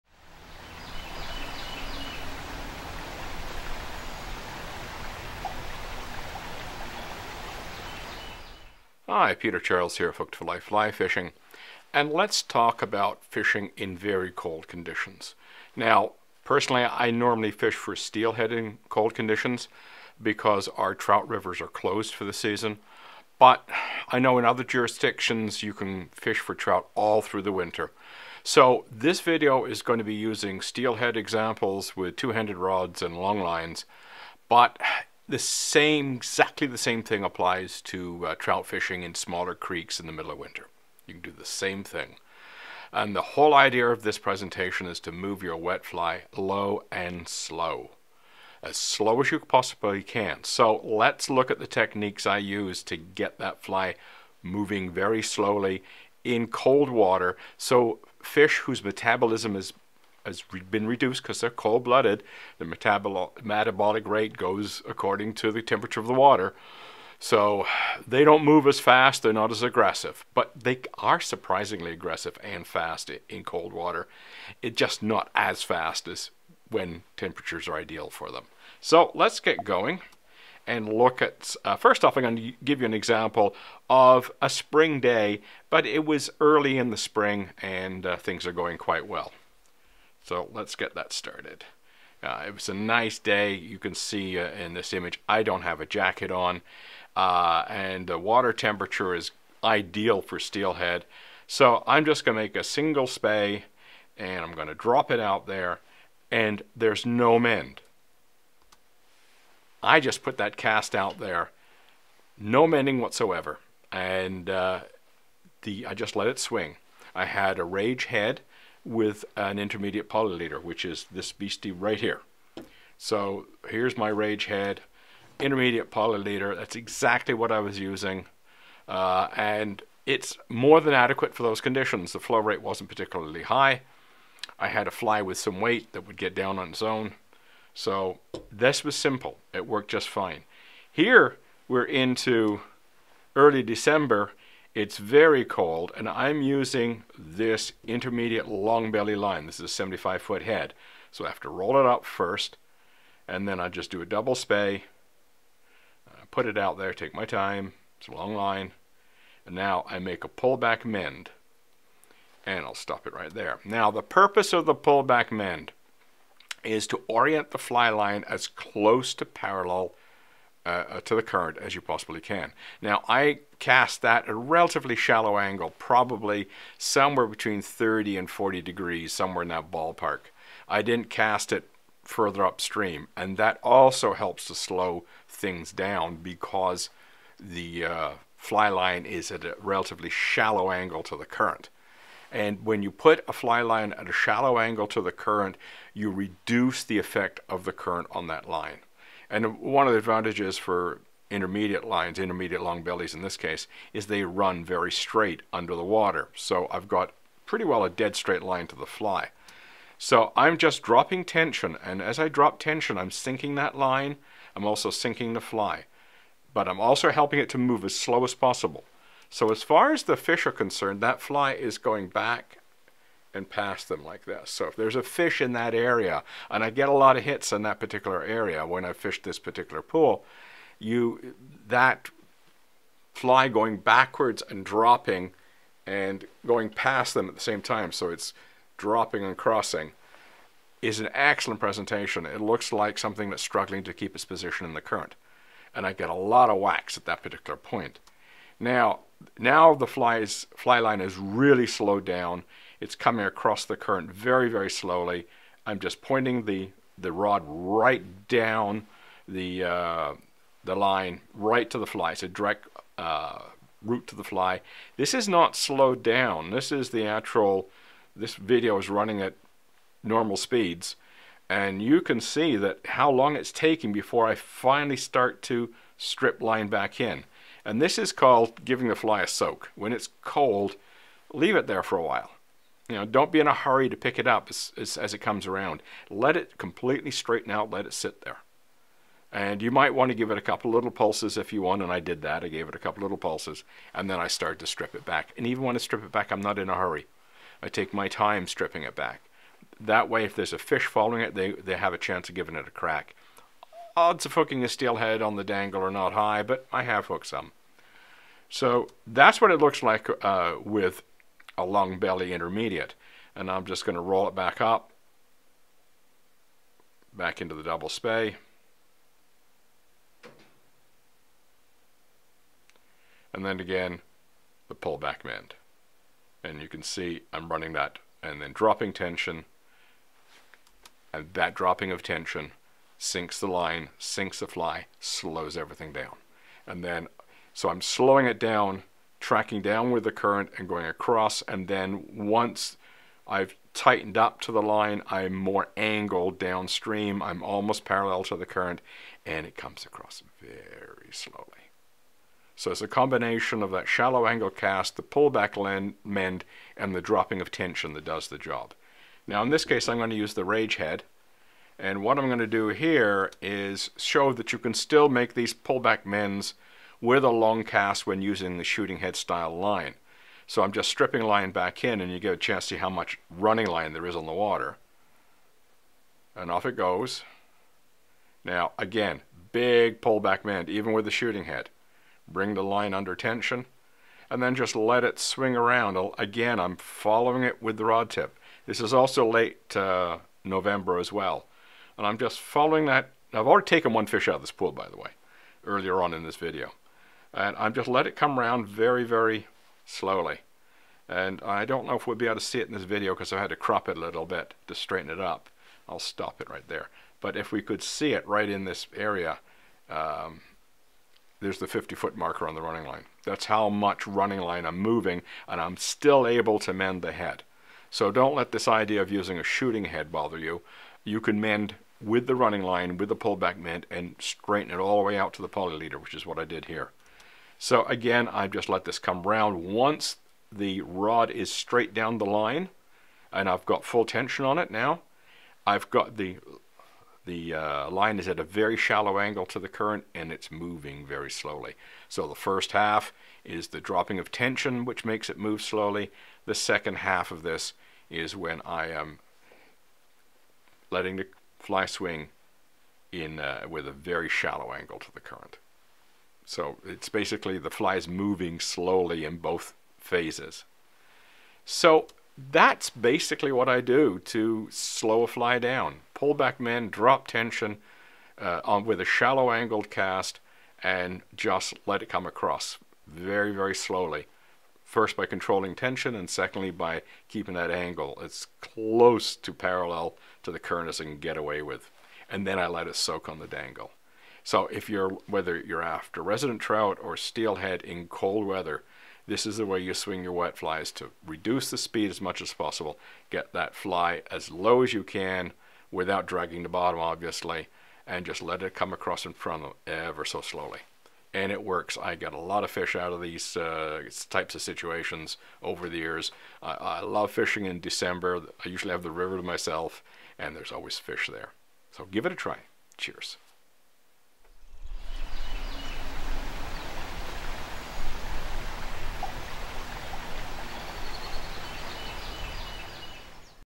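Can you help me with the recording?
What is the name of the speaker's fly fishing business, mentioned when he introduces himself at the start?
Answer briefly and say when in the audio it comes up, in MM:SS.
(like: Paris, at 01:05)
Hooked for Life Fly Fishing, at 00:10.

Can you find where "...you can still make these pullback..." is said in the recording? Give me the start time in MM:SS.
06:04.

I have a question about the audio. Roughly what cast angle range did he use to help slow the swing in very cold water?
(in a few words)
30 to 40 degrees.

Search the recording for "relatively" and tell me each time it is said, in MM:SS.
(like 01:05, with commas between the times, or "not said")
02:54, 03:09.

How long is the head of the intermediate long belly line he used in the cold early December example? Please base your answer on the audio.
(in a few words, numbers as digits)
75 feet.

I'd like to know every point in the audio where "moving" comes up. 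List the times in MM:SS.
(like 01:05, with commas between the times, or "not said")
00:54, 06:54, 07:20, 07:38.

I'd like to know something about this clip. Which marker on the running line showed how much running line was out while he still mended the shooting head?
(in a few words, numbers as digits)
50-foot marker.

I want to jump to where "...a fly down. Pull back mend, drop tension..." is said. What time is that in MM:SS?
07:45.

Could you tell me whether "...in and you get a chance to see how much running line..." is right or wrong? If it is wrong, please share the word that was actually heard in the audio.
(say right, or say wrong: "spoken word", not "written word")
right.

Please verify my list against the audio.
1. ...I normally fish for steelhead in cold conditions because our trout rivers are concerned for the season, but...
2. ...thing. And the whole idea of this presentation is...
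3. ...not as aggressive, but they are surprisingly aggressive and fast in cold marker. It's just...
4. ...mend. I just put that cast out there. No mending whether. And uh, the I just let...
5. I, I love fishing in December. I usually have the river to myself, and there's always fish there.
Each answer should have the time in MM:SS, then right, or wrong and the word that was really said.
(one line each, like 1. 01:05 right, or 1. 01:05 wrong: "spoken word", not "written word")
1. 00:16 wrong: "closed", not "concerned"
2. 00:41 right
3. 01:09 wrong: "water", not "marker"
4. 01:47 wrong: "whatsoever", not "whether"
5. 08:26 right.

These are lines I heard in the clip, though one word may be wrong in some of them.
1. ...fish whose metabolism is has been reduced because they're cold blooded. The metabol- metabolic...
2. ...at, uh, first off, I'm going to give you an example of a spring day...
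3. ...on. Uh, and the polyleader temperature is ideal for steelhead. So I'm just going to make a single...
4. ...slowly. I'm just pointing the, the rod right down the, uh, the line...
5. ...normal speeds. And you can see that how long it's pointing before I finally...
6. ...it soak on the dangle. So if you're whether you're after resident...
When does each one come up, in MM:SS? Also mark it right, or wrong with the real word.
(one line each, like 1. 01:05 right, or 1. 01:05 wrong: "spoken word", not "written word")
1. 00:58 right
2. 01:21 right
3. 01:36 wrong: "water", not "polyleader"
4. 04:14 right
5. 04:30 wrong: "taking", not "pointing"
6. 08:02 right.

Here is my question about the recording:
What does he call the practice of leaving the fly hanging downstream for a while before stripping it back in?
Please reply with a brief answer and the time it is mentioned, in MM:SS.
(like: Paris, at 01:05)
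Giving the fly a soak, at 04:38.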